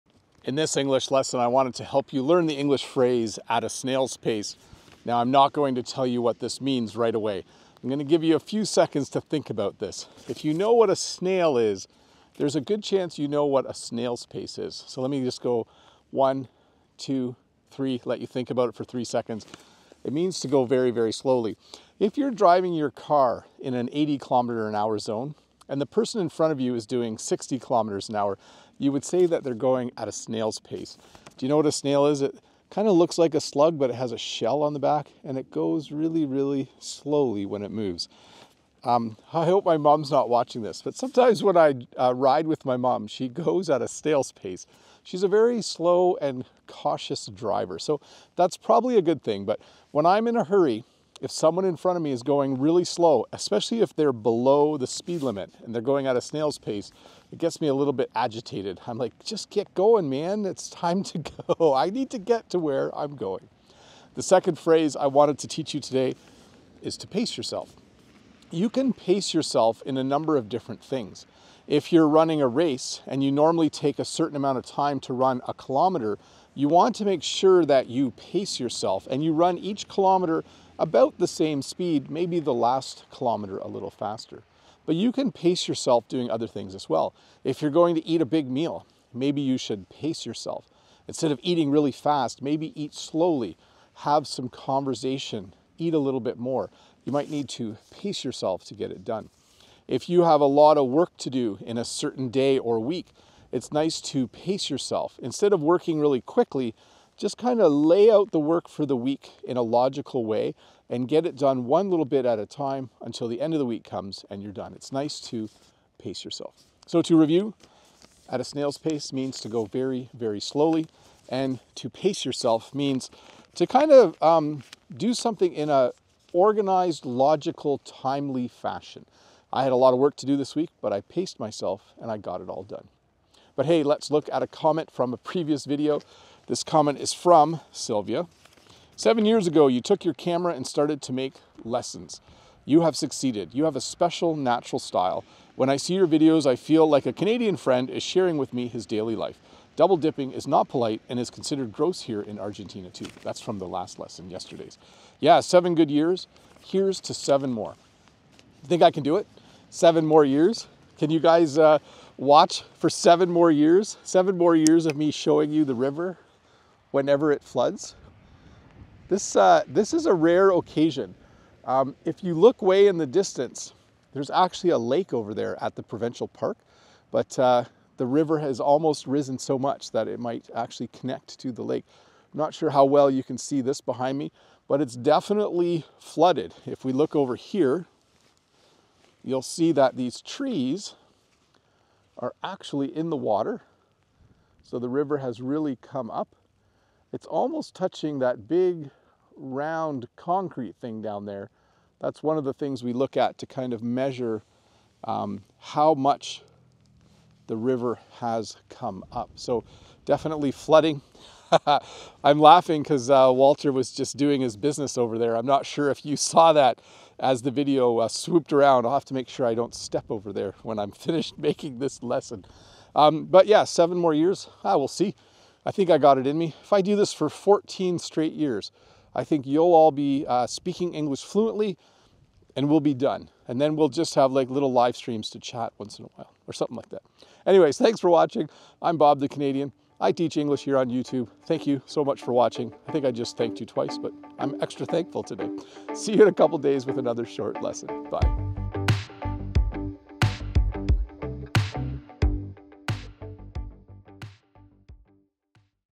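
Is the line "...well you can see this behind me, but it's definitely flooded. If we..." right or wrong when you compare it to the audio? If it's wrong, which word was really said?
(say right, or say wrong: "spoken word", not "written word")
right.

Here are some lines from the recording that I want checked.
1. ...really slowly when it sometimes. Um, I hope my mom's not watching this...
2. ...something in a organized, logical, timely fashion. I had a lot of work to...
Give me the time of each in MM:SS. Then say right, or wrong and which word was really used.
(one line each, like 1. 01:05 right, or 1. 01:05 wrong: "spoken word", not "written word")
1. 00:36 wrong: "moves", not "sometimes"
2. 02:05 right.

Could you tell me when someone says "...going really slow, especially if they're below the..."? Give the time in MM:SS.
00:52.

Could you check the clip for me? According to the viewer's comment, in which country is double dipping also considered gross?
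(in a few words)
Argentina.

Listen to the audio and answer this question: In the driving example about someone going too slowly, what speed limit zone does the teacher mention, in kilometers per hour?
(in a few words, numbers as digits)
80.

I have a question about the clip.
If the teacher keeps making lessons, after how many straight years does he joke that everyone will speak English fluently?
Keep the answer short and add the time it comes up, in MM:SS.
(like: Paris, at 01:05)
14, at 03:47.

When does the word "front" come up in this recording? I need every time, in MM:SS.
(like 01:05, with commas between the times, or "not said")
00:26, 00:51.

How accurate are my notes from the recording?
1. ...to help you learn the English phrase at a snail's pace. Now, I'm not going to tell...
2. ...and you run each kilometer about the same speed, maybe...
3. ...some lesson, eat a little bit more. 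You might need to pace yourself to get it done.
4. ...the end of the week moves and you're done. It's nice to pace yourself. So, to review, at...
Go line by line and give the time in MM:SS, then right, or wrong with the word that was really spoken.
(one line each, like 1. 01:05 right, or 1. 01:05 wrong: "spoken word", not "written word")
1. 00:01 right
2. 01:19 right
3. 01:34 wrong: "conversation", not "lesson"
4. 01:53 wrong: "comes", not "moves".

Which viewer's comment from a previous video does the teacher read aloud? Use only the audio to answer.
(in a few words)
Sylvia.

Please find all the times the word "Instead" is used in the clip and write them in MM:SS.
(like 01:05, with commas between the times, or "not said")
01:31, 01:45.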